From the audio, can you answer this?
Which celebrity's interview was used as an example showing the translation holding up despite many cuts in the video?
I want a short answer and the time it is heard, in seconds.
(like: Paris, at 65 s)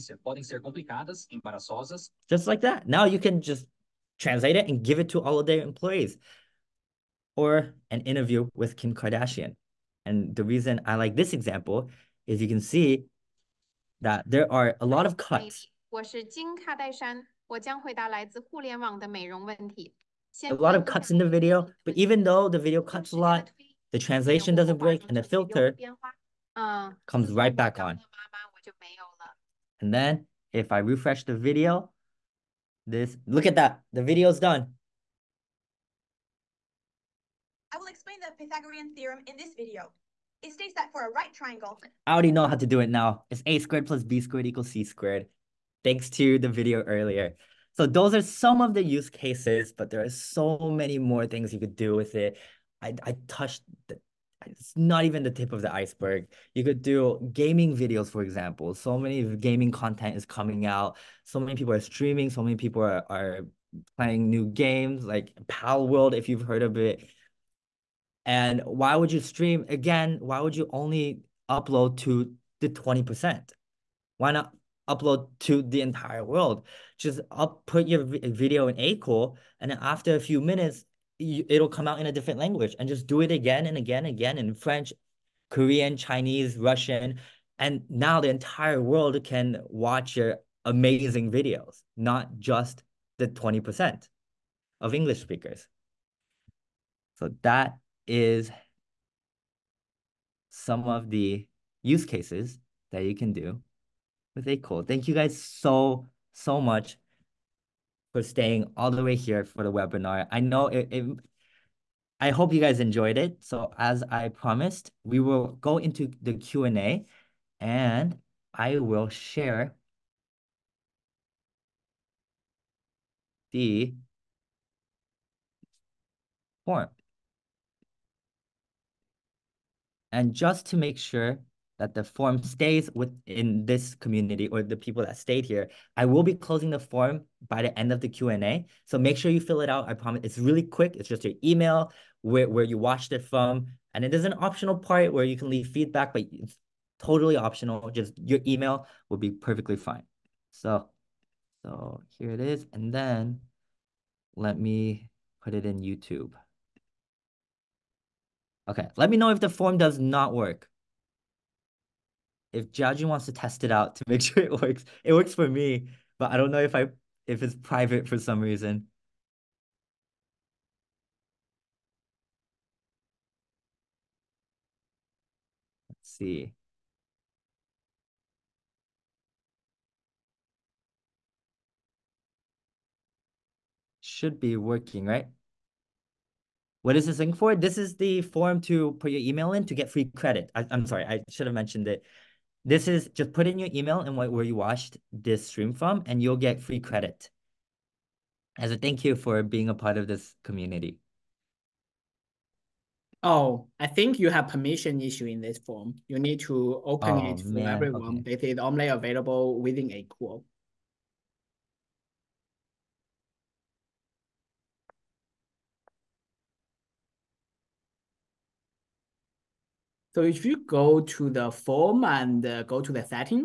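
Kim Kardashian, at 8 s.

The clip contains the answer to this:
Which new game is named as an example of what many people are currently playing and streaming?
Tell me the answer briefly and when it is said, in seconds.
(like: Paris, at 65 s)
Palworld, at 65 s.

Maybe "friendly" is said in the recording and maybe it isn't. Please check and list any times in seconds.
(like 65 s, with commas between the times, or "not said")
not said.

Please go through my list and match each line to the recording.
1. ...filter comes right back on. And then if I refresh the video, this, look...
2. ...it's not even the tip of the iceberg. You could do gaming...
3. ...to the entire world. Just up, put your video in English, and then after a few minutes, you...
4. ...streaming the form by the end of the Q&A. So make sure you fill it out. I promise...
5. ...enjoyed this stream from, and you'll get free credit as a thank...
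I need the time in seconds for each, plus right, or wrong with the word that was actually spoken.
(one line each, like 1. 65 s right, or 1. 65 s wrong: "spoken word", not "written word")
1. 25 s right
2. 54 s right
3. 75 s wrong: "Akool", not "English"
4. 136 s wrong: "closing", not "streaming"
5. 194 s wrong: "watched", not "enjoyed".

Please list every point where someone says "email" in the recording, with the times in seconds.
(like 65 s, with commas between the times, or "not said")
141 s, 148 s, 189 s, 193 s.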